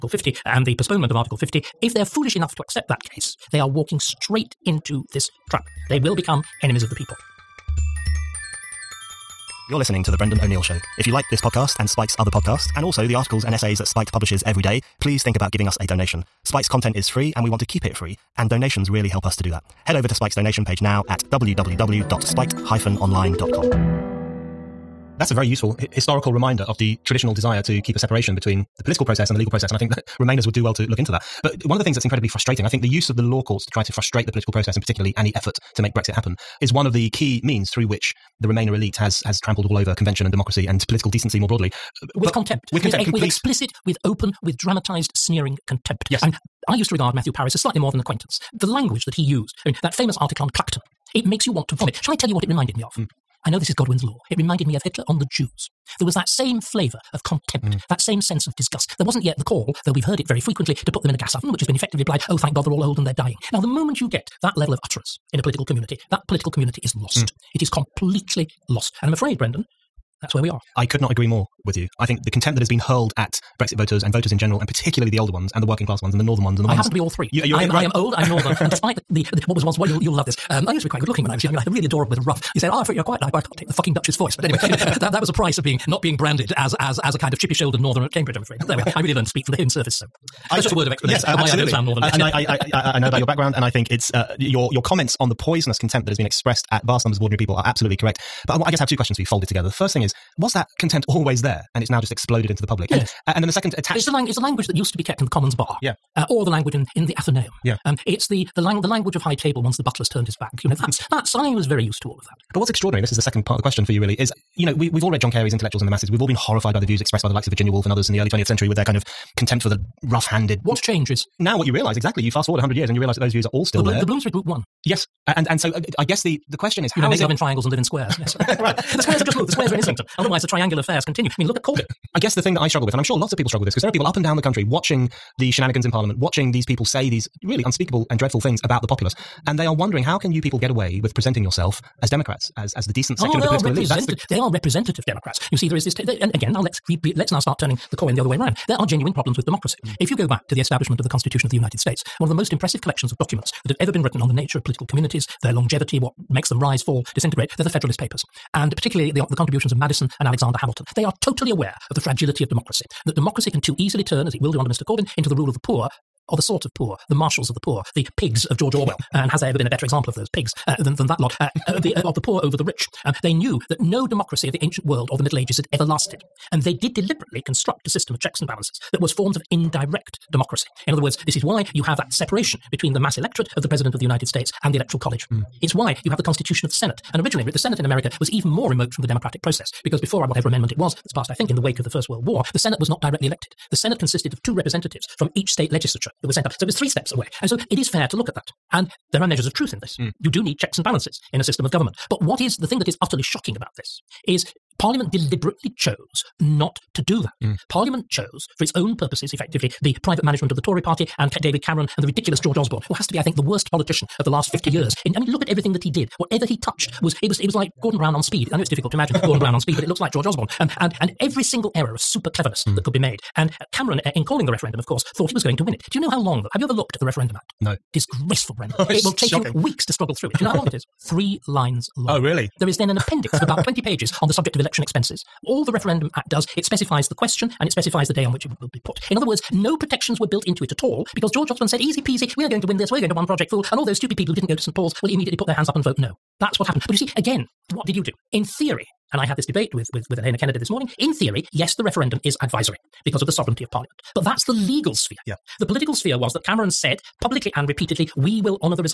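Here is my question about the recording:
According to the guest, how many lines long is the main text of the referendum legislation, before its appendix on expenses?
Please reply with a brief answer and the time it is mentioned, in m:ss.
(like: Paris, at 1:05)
3, at 3:51.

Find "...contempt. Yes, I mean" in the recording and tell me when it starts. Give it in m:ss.
0:45.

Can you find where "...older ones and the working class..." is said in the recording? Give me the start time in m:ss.
1:15.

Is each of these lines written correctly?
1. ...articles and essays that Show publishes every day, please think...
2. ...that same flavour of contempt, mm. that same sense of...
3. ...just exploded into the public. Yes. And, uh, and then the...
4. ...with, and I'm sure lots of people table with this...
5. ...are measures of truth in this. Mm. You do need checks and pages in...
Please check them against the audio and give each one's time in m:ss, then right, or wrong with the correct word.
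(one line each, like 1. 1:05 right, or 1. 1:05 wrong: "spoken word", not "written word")
1. 0:13 wrong: "Spiked", not "Show"
2. 0:56 right
3. 1:42 right
4. 2:12 wrong: "struggle", not "table"
5. 3:19 wrong: "balances", not "pages".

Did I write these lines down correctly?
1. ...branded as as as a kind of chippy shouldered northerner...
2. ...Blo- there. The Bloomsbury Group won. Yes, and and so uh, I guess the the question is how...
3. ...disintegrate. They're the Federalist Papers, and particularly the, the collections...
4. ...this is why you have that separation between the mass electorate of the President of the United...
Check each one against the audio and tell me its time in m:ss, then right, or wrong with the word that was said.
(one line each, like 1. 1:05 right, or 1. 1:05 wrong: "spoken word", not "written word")
1. 1:26 right
2. 2:03 right
3. 2:37 wrong: "contributions", not "collections"
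4. 3:01 right.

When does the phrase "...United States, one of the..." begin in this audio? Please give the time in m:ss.
2:31.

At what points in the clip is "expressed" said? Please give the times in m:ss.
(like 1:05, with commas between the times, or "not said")
1:36, 1:57.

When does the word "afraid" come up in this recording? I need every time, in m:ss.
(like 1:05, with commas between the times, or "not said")
1:09, 1:28.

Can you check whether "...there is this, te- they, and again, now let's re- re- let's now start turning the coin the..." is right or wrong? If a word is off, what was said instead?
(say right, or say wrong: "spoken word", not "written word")
right.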